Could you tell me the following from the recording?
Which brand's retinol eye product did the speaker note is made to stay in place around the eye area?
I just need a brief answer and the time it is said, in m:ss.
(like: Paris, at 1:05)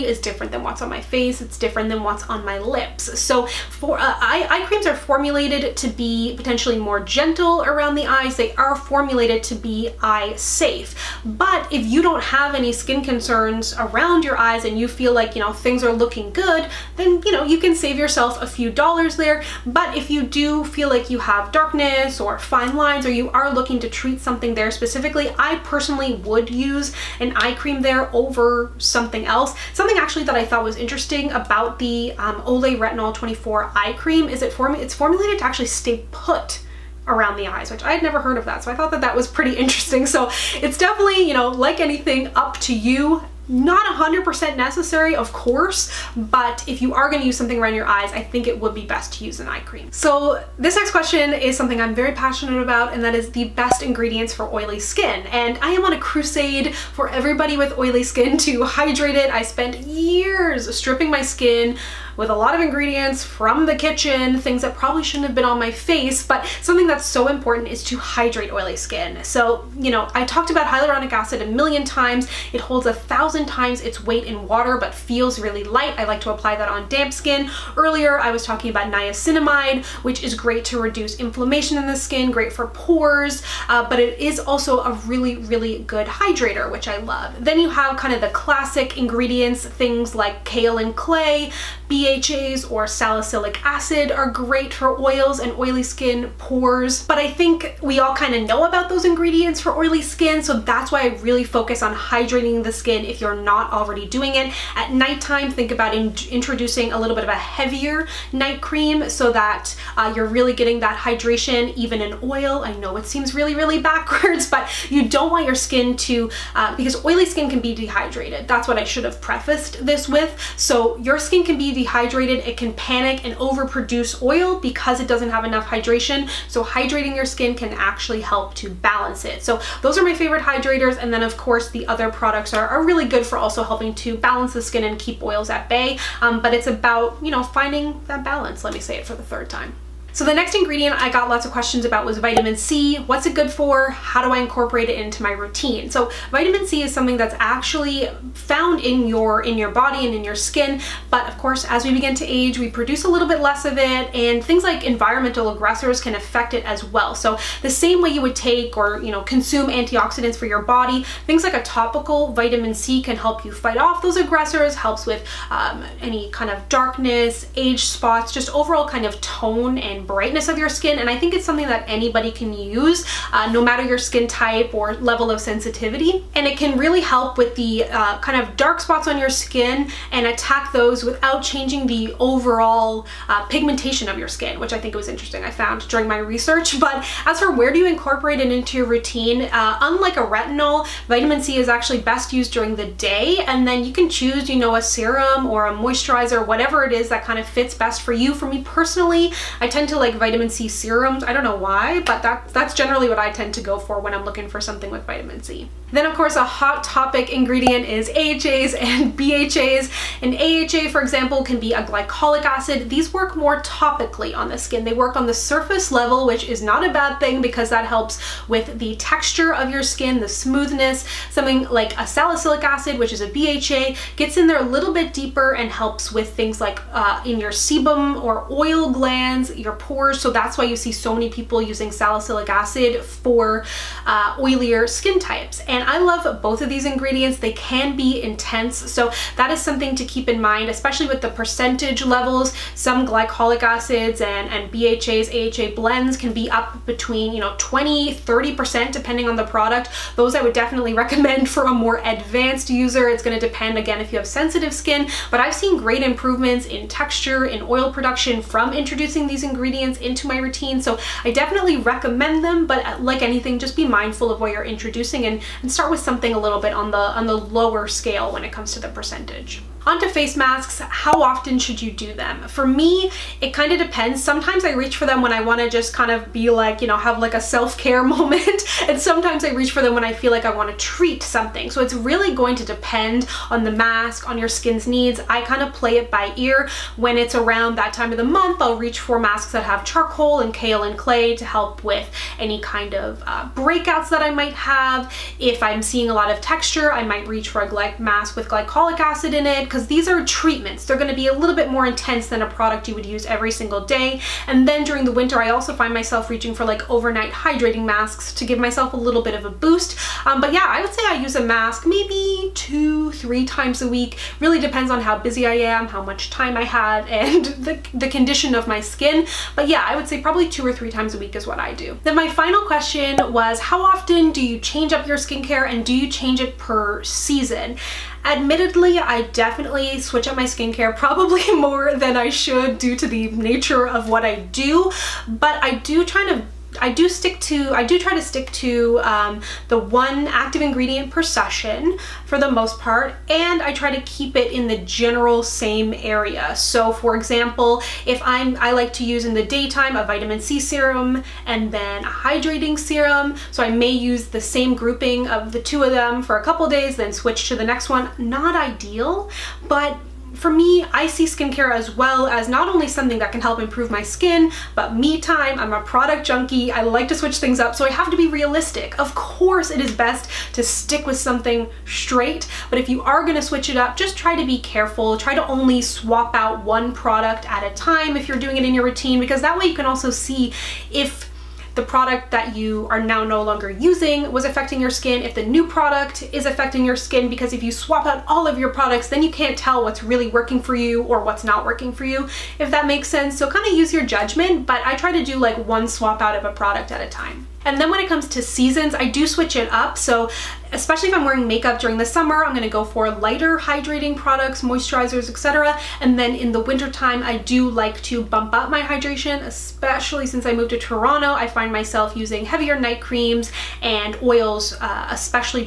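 Olay, at 0:32.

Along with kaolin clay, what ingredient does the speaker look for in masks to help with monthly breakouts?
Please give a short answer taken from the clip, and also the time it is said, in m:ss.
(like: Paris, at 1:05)
charcoal, at 4:49.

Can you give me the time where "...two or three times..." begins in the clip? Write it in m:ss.
5:20.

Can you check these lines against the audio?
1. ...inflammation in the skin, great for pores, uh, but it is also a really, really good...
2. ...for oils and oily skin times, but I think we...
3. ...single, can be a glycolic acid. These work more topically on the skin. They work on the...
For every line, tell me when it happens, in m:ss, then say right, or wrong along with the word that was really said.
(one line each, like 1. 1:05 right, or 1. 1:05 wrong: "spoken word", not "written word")
1. 1:21 right
2. 1:34 wrong: "pores", not "times"
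3. 3:31 wrong: "example", not "single".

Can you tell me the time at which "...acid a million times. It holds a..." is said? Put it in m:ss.
1:11.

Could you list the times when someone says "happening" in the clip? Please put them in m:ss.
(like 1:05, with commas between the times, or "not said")
not said.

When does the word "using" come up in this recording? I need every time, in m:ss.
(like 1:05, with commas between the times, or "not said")
3:51, 6:23, 6:52.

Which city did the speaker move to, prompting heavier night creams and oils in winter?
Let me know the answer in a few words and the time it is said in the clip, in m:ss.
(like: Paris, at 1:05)
Toronto, at 6:50.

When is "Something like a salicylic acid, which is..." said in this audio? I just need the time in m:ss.
3:41.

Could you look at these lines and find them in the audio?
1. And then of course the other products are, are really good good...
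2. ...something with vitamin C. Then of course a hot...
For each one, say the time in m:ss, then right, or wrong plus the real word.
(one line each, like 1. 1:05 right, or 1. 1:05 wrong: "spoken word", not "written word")
1. 2:11 right
2. 3:24 right.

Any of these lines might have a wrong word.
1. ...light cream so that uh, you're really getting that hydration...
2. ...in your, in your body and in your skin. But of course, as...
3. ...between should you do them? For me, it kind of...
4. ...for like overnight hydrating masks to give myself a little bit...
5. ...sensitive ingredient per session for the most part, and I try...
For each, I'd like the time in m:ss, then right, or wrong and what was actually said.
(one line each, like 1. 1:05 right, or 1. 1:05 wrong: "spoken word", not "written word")
1. 1:48 wrong: "night", not "light"
2. 2:28 right
3. 4:31 wrong: "often", not "between"
4. 5:06 right
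5. 5:40 wrong: "active", not "sensitive".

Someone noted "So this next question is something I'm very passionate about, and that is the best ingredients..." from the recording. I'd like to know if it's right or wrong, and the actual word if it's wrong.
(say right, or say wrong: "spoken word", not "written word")
right.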